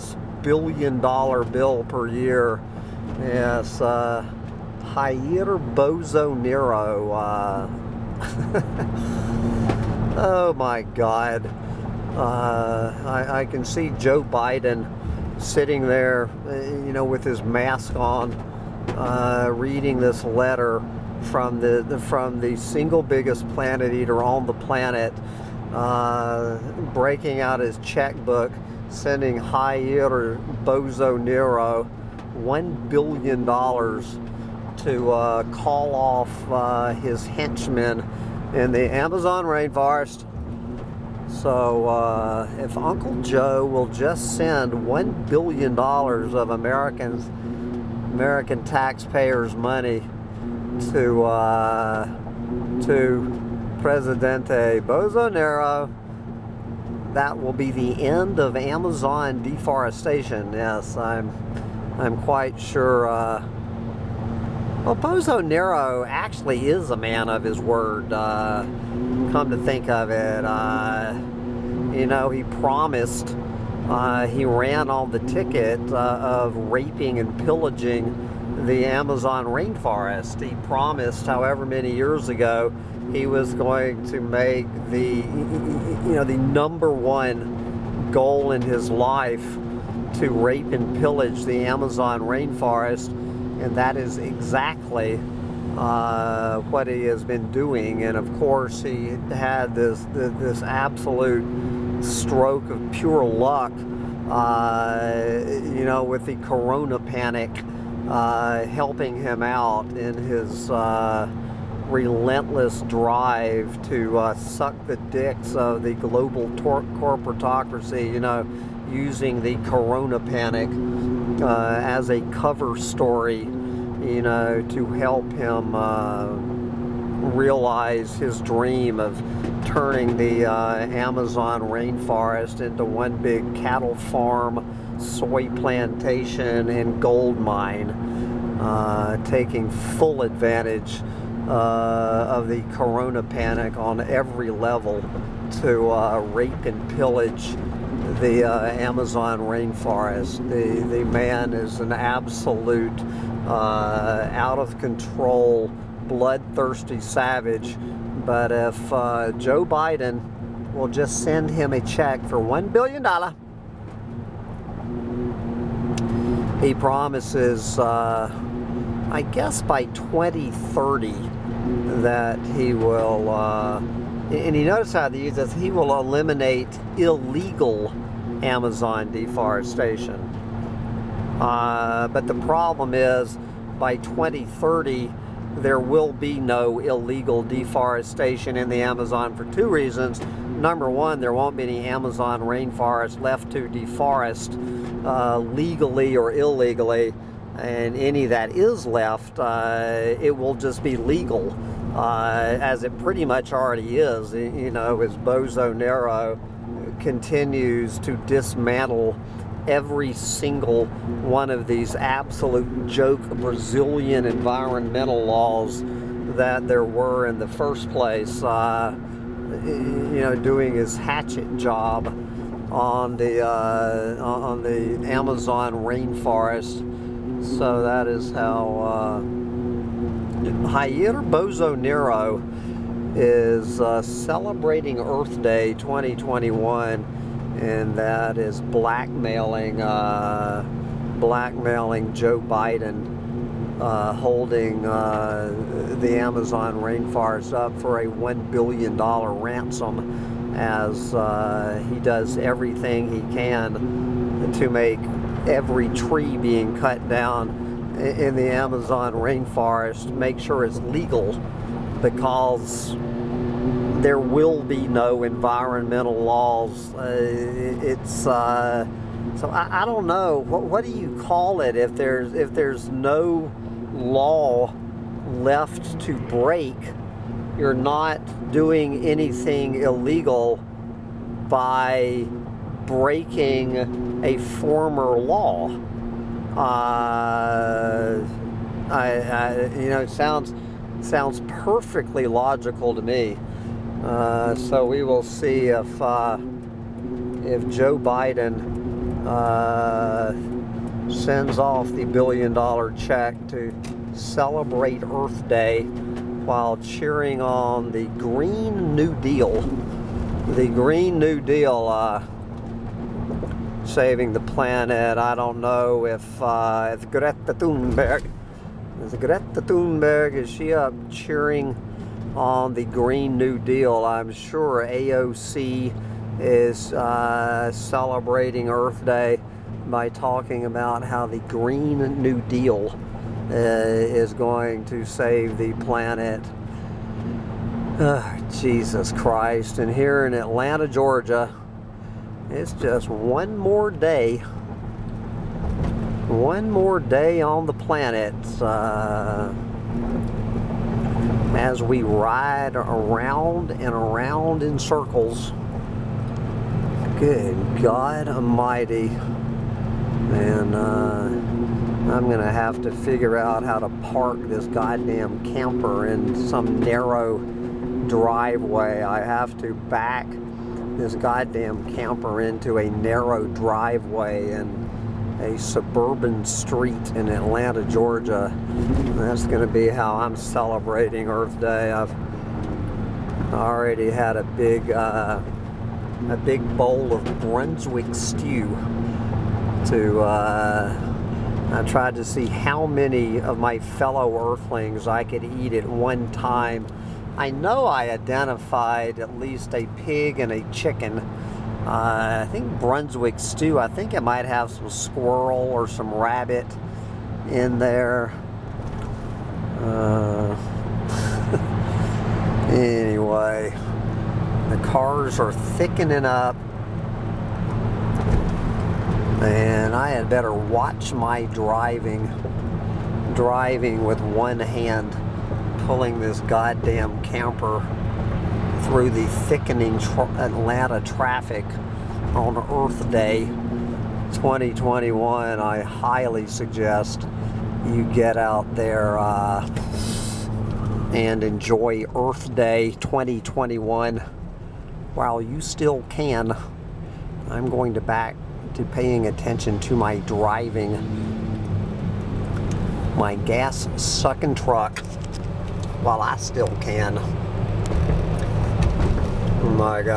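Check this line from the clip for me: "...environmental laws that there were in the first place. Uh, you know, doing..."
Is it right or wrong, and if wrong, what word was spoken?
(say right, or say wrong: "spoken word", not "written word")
right.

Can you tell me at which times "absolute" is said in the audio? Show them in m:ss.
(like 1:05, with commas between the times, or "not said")
1:40, 2:31, 3:31.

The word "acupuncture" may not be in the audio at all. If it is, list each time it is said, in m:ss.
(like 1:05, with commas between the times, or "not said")
not said.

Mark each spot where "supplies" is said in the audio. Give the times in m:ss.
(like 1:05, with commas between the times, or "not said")
not said.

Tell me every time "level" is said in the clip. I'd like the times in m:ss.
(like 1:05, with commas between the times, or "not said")
2:24.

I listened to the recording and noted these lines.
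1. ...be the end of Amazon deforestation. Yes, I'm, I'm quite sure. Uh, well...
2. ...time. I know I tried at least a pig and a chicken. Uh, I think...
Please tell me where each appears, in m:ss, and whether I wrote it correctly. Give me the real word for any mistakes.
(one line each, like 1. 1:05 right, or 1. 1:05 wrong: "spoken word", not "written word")
1. 0:57 right
2. 6:36 wrong: "identified", not "tried".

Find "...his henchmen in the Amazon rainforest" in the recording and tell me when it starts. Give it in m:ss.
0:36.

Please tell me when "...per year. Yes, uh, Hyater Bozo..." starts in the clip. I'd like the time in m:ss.
0:01.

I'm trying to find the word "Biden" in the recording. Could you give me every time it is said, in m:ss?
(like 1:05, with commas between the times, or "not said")
0:14, 2:39, 4:02, 4:57.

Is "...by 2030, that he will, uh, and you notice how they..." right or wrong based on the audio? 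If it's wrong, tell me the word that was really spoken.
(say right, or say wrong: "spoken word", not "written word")
right.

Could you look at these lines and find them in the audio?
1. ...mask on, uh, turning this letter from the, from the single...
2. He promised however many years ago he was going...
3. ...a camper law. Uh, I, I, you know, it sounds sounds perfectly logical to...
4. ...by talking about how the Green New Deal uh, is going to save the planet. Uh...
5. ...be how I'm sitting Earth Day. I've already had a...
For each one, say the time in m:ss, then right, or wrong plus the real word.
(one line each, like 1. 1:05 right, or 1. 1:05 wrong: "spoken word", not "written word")
1. 0:17 wrong: "reading", not "turning"
2. 1:20 right
3. 4:44 wrong: "former", not "camper"
4. 5:29 right
5. 6:19 wrong: "celebrating", not "sitting".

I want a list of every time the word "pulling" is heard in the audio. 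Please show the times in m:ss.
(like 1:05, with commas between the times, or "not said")
7:05.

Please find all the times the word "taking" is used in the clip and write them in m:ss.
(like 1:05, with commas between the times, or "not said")
2:19.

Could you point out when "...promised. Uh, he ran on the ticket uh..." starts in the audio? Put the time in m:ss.
1:12.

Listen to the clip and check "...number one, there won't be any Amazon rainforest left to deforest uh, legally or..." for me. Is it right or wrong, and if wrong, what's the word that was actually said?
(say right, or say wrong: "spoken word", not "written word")
right.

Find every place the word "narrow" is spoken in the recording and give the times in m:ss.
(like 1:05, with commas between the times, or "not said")
6:06, 6:12.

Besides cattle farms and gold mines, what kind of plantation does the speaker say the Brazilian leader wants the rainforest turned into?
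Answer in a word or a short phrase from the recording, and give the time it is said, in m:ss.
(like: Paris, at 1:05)
Soy plantation, at 2:15.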